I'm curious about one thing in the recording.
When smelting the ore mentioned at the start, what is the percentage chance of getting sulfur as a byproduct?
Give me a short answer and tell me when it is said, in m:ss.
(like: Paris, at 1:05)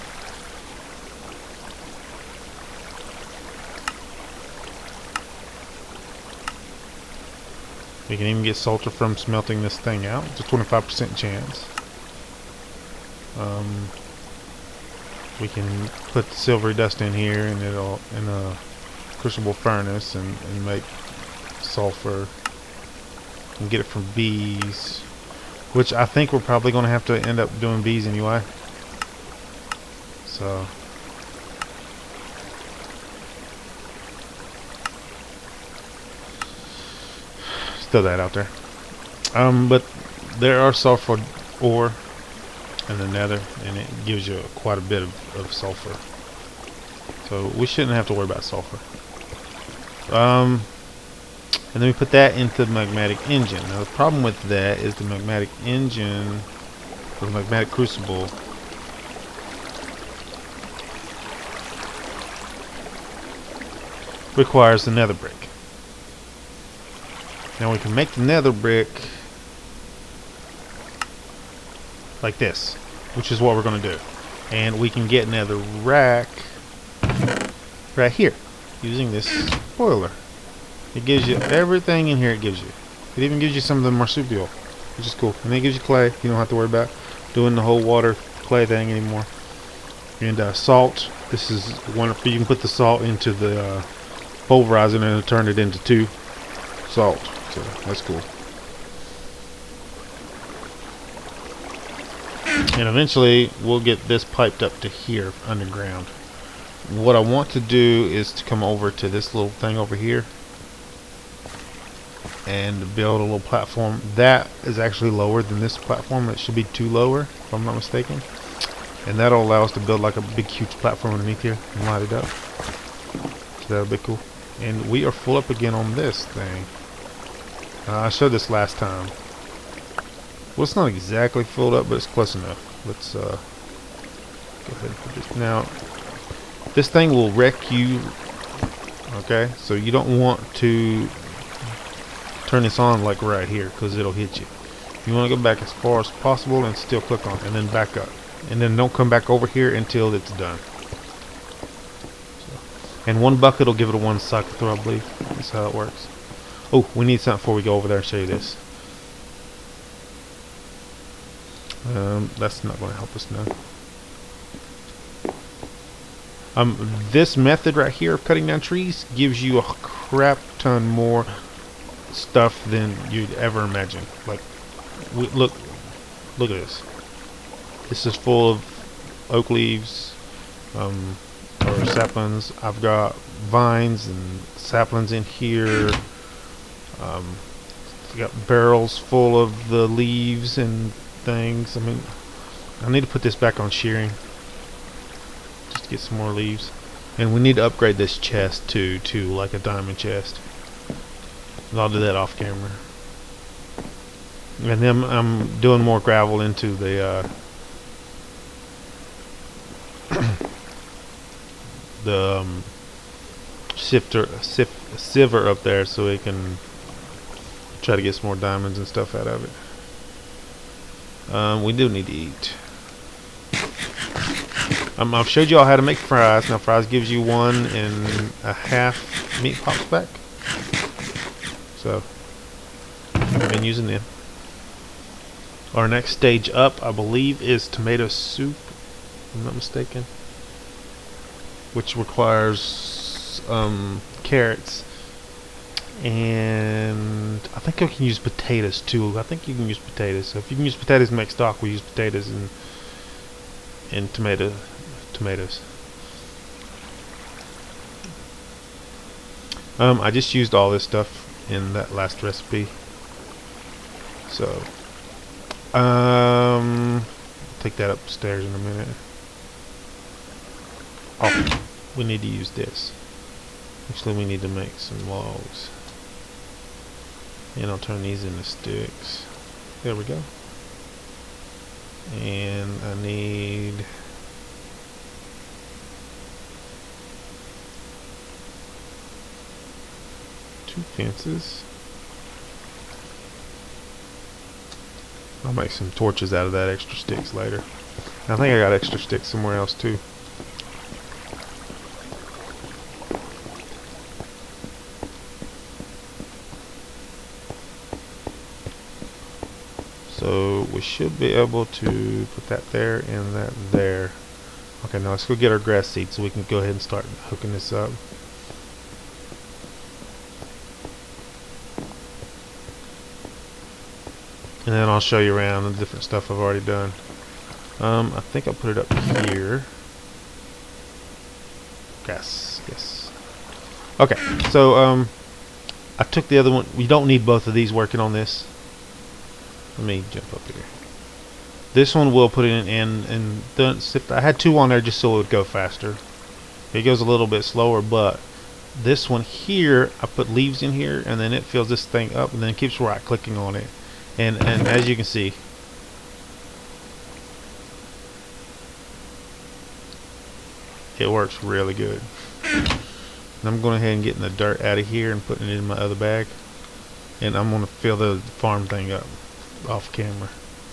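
25%, at 0:10.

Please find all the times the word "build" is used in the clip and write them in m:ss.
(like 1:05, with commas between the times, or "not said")
1:52, 1:59.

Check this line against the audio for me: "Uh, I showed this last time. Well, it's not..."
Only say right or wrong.
right.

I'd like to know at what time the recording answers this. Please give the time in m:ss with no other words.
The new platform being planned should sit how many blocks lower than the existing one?
1:56.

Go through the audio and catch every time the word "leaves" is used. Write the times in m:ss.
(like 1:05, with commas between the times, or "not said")
2:59, 3:09, 3:16, 5:50.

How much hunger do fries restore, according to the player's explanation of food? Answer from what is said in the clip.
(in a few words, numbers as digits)
1.5 meat pops.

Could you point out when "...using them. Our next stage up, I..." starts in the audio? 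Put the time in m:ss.
3:53.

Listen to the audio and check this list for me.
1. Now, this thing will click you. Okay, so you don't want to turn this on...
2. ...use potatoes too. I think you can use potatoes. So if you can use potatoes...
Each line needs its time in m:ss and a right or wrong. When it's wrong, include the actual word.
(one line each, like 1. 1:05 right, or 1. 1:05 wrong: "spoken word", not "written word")
1. 2:15 wrong: "wreck", not "click"
2. 4:08 right.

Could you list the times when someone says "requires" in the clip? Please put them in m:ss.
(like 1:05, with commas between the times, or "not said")
1:04, 4:01.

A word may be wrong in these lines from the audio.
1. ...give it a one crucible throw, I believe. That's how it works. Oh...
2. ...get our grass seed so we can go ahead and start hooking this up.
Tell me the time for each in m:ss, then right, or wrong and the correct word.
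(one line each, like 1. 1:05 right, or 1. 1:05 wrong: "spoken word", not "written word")
1. 2:33 wrong: "cycle", not "crucible"
2. 5:15 right.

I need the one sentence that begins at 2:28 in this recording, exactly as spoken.
And then don't come back over here until it's done.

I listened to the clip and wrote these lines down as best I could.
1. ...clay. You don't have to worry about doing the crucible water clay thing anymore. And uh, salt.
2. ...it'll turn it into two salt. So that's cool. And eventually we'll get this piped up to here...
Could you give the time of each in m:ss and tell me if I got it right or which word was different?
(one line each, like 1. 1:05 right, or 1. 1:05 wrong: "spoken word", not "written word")
1. 1:25 wrong: "whole", not "crucible"
2. 1:35 right.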